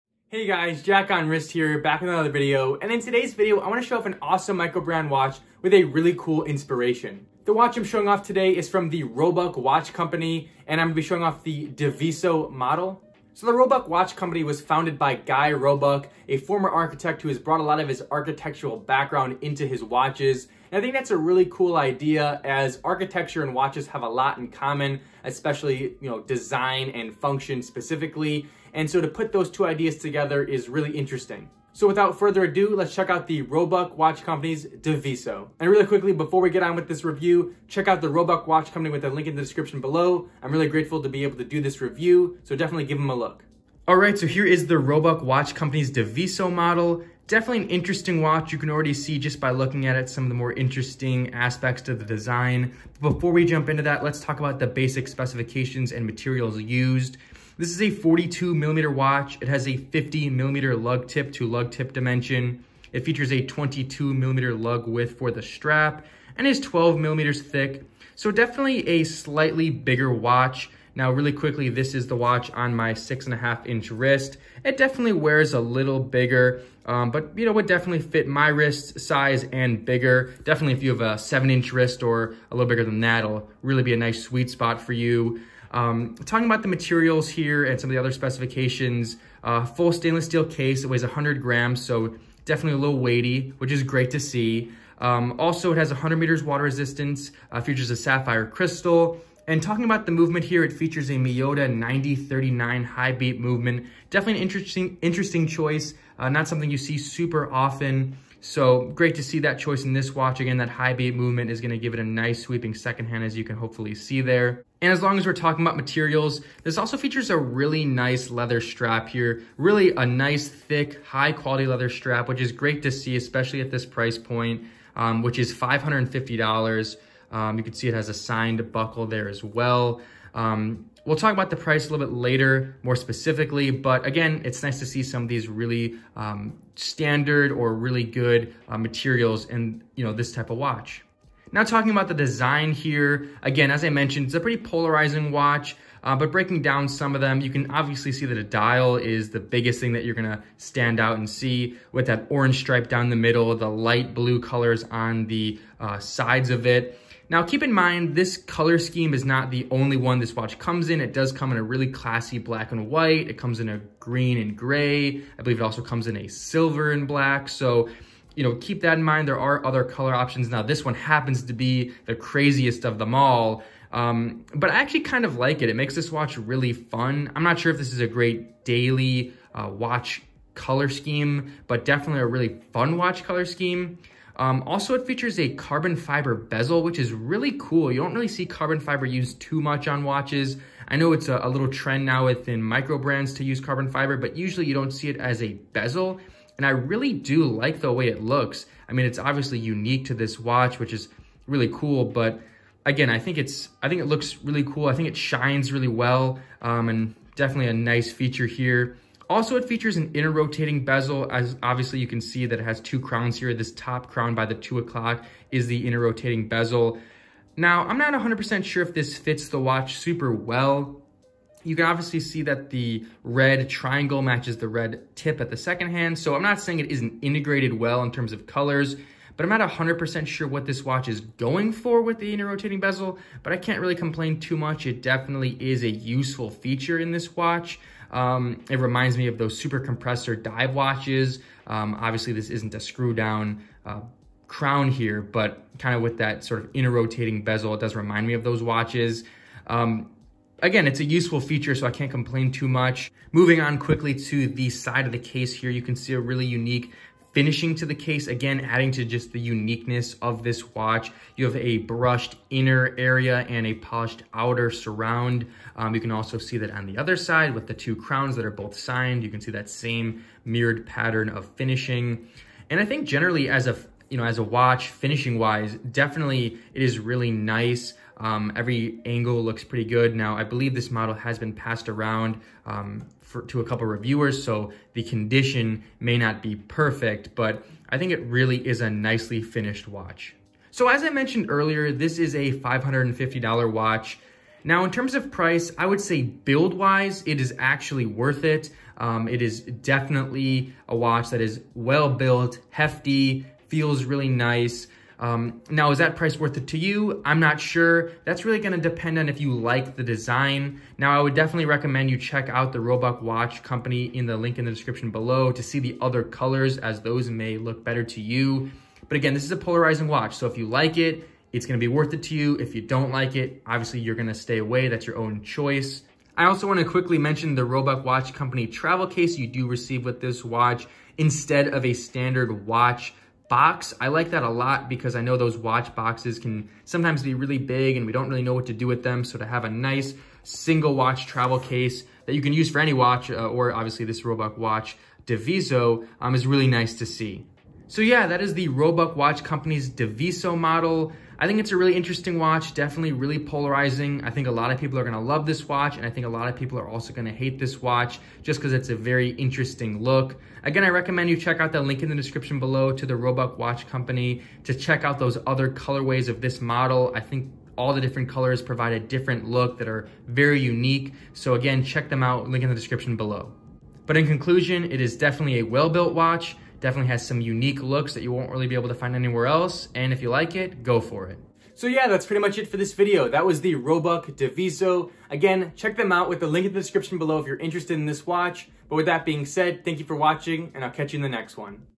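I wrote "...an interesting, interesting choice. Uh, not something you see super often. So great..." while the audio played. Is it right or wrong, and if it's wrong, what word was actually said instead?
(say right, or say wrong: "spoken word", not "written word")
right.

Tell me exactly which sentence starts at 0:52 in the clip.
But before we jump into that, let's talk about the basic specifications and materials used.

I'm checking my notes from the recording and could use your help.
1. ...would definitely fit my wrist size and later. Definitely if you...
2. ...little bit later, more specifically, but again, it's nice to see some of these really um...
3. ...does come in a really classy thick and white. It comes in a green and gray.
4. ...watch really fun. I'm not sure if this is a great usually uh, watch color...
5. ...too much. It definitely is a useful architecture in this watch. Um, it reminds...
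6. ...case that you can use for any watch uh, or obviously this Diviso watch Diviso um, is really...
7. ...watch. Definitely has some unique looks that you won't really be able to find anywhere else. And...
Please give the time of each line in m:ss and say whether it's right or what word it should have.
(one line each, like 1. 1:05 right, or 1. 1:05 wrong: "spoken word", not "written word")
1. 1:17 wrong: "bigger", not "later"
2. 2:11 right
3. 2:41 wrong: "black", not "thick"
4. 2:56 wrong: "daily", not "usually"
5. 3:54 wrong: "feature", not "architecture"
6. 5:41 wrong: "Roebuck", not "Diviso"
7. 6:16 right.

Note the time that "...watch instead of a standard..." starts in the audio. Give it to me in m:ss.
5:30.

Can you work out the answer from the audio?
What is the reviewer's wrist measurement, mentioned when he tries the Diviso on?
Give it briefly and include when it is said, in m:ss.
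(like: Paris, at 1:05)
6.5 inches, at 1:12.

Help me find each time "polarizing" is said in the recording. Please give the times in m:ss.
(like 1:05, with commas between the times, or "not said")
2:24, 5:19, 5:53.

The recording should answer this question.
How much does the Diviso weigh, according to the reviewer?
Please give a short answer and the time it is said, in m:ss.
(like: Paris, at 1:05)
100 grams, at 1:31.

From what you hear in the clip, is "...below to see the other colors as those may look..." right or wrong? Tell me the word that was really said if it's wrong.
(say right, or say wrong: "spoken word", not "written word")
right.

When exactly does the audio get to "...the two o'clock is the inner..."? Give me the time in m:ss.
3:34.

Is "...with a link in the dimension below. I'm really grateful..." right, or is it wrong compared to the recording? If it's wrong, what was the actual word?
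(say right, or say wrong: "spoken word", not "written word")
wrong: "description", not "dimension".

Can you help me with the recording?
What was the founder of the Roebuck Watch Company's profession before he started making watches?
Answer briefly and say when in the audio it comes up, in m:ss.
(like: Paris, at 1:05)
Architect, at 0:16.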